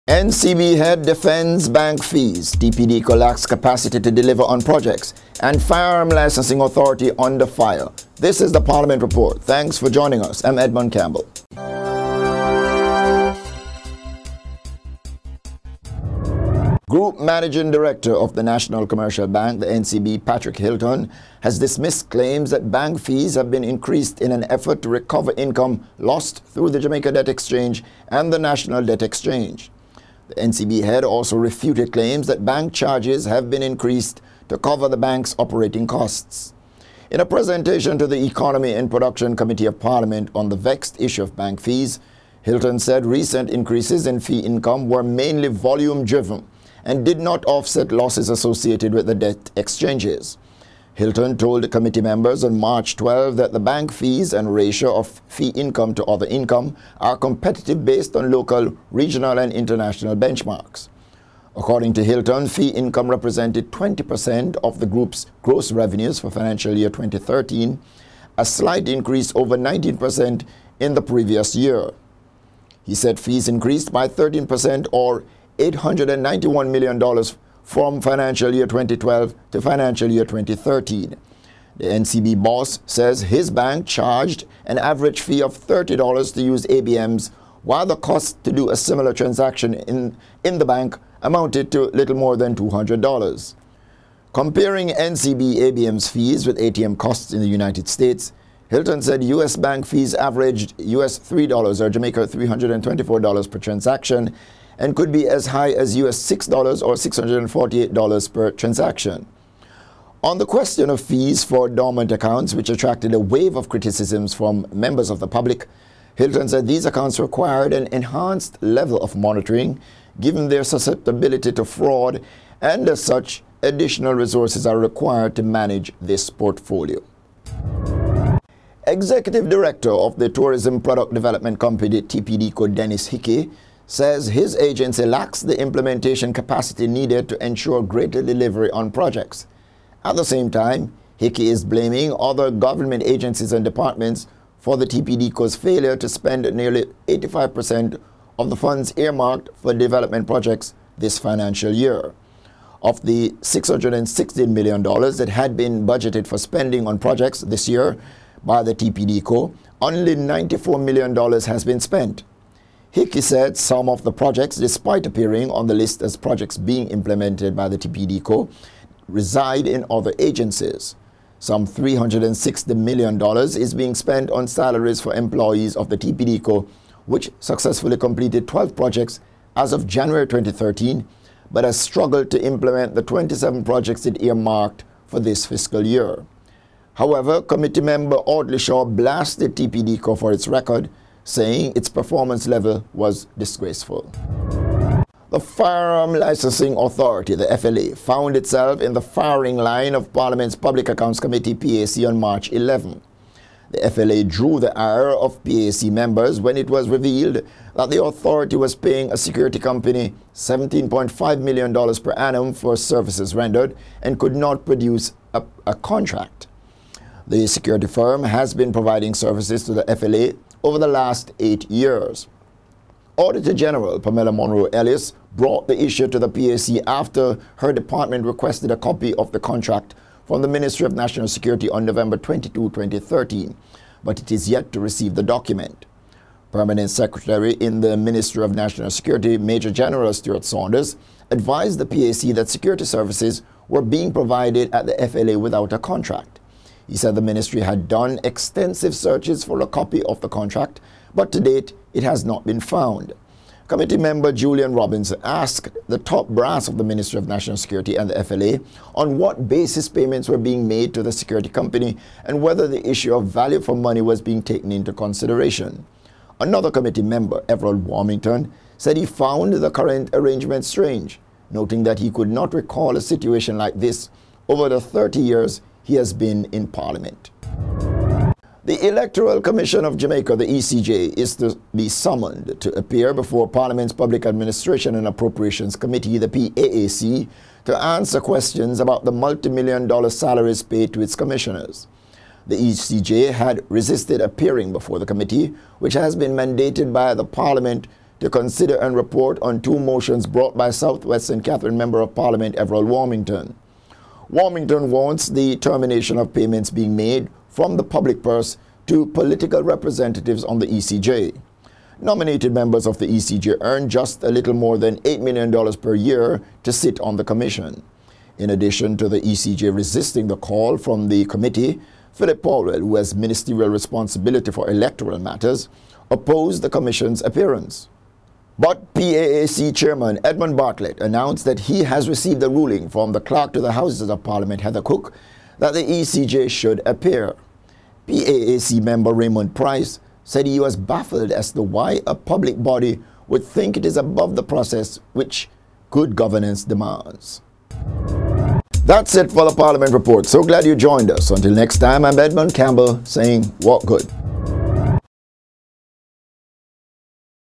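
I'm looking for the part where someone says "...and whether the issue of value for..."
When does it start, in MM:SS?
04:22.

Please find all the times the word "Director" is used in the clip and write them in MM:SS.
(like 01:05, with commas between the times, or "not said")
00:17, 02:09.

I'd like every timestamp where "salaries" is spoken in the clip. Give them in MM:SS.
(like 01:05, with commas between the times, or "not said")
02:54, 04:50.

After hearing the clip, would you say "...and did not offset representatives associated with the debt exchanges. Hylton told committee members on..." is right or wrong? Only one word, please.
wrong.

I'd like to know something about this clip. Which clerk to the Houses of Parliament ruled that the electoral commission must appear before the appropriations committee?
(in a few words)
Heather Cook.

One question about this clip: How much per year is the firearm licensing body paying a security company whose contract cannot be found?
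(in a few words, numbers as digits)
$17.5 million.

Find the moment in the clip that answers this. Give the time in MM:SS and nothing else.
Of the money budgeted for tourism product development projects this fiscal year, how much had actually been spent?
02:40.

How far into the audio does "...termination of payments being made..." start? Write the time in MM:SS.
05:05.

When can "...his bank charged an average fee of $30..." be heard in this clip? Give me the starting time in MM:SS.
01:23.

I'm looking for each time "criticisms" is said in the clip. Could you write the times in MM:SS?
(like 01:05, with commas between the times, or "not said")
01:53.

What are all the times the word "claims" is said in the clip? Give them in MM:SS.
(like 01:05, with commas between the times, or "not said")
00:22, 00:31.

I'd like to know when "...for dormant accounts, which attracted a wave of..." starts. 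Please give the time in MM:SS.
01:51.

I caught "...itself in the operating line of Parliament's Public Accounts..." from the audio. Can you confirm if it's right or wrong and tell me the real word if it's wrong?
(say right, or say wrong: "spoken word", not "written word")
wrong: "firing", not "operating".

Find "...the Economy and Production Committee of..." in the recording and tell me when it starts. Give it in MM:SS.
00:38.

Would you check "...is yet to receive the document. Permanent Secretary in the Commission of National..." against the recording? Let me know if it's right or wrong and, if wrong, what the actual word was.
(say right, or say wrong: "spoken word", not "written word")
wrong: "Ministry", not "Commission".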